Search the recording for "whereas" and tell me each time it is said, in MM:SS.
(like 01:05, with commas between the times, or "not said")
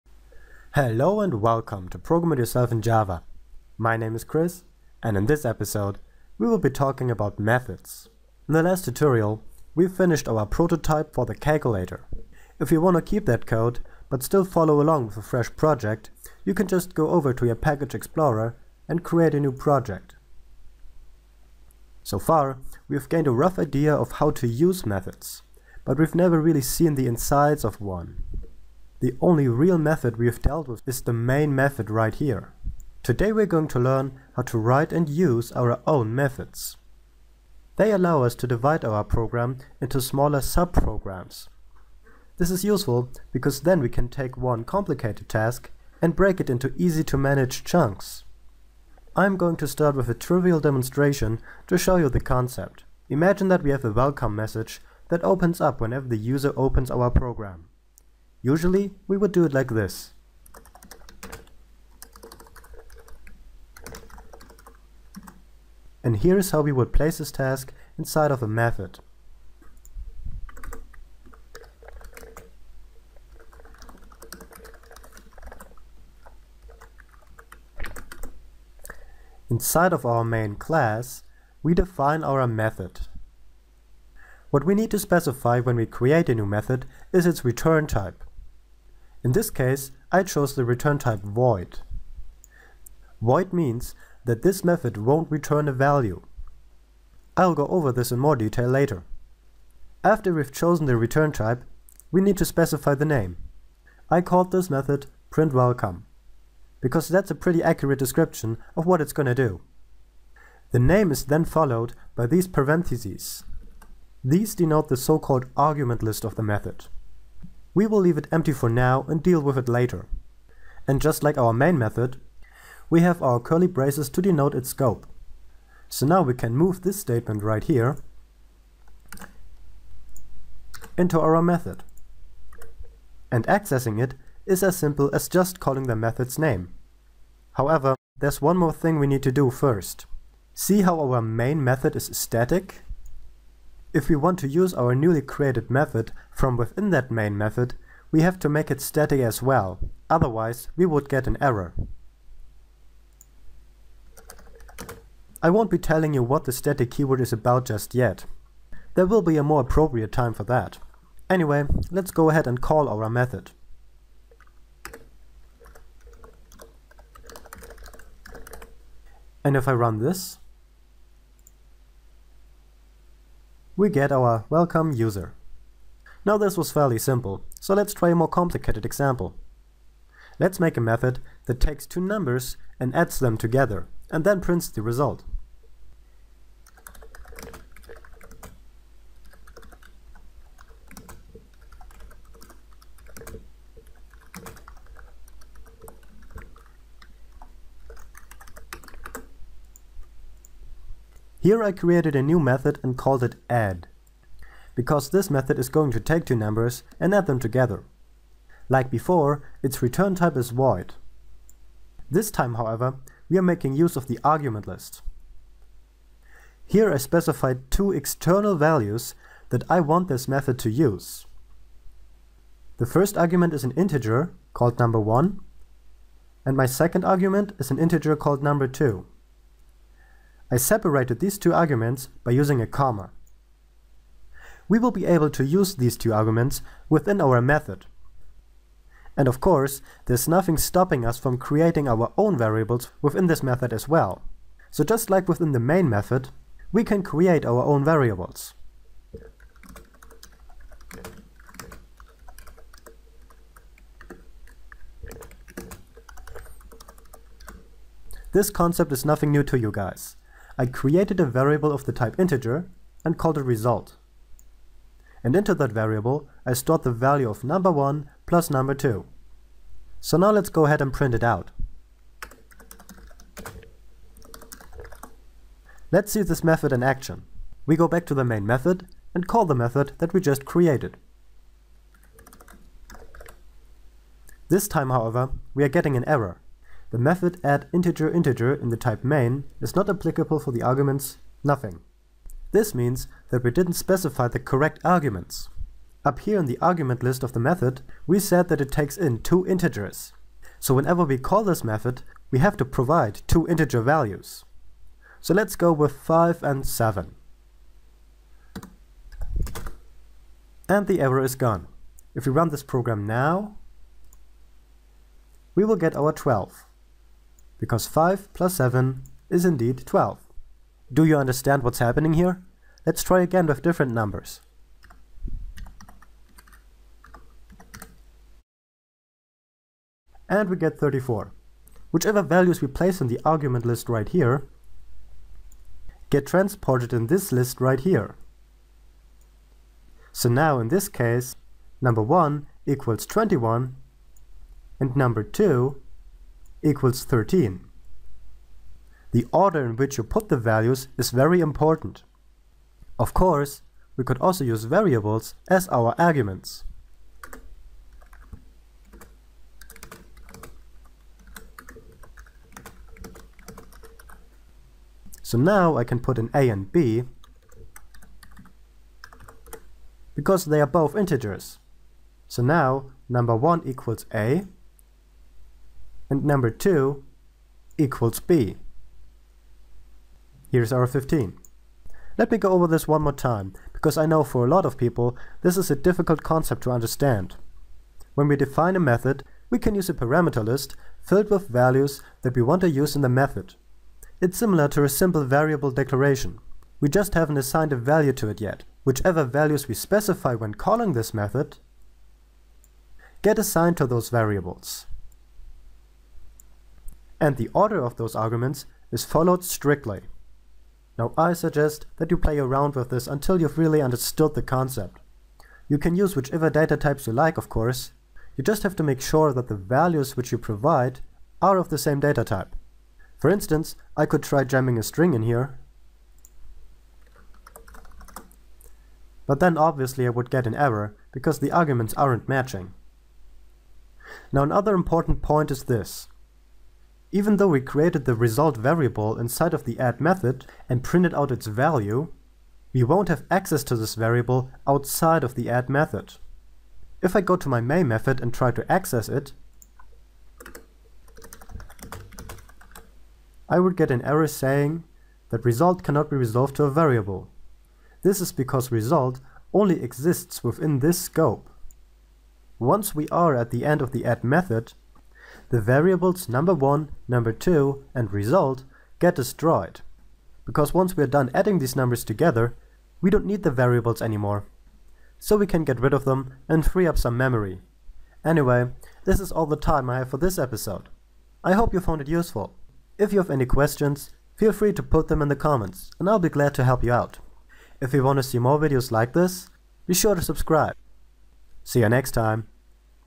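not said.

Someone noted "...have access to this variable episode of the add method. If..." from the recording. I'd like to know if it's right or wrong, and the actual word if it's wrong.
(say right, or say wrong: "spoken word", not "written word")
wrong: "outside", not "episode".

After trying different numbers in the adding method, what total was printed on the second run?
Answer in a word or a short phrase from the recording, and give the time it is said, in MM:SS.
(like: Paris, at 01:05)
34, at 05:30.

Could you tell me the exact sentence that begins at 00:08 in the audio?
In the last tutorial we finished our prototype for the calculator.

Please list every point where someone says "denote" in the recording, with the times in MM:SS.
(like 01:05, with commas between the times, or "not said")
01:54, 02:04.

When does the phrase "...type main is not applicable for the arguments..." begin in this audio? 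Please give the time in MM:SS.
04:48.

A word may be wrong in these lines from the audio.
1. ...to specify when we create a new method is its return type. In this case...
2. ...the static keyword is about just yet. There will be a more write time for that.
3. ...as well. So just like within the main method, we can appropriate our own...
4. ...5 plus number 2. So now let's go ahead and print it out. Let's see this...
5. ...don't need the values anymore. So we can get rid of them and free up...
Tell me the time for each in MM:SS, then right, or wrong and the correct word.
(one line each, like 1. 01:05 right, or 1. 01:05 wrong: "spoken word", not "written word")
1. 01:24 right
2. 02:36 wrong: "appropriate", not "write"
3. 04:03 wrong: "create", not "appropriate"
4. 04:27 wrong: "1", not "5"
5. 07:53 wrong: "variables", not "values".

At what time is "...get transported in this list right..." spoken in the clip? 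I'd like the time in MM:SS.
05:36.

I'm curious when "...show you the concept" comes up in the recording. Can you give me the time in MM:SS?
00:51.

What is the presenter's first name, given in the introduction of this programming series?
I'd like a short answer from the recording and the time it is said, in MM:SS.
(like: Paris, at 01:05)
Chris, at 00:04.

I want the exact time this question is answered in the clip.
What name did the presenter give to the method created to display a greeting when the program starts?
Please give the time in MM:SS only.
01:45.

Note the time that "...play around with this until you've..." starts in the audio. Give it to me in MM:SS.
06:52.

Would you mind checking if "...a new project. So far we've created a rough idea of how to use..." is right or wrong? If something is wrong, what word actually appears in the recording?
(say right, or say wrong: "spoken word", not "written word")
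wrong: "gained", not "created".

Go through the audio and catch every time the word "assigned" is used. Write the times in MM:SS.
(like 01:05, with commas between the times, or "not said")
06:37, 06:43.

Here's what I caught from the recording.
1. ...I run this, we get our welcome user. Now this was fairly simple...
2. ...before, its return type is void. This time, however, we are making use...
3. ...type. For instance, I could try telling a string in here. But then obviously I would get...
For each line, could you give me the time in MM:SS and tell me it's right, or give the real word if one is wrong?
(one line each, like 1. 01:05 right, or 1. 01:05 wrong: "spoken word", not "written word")
1. 02:49 right
2. 03:28 right
3. 07:02 wrong: "jamming", not "telling".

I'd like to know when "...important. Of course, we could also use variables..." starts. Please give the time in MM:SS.
05:51.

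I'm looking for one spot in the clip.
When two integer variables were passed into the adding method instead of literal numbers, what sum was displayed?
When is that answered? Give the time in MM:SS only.
06:20.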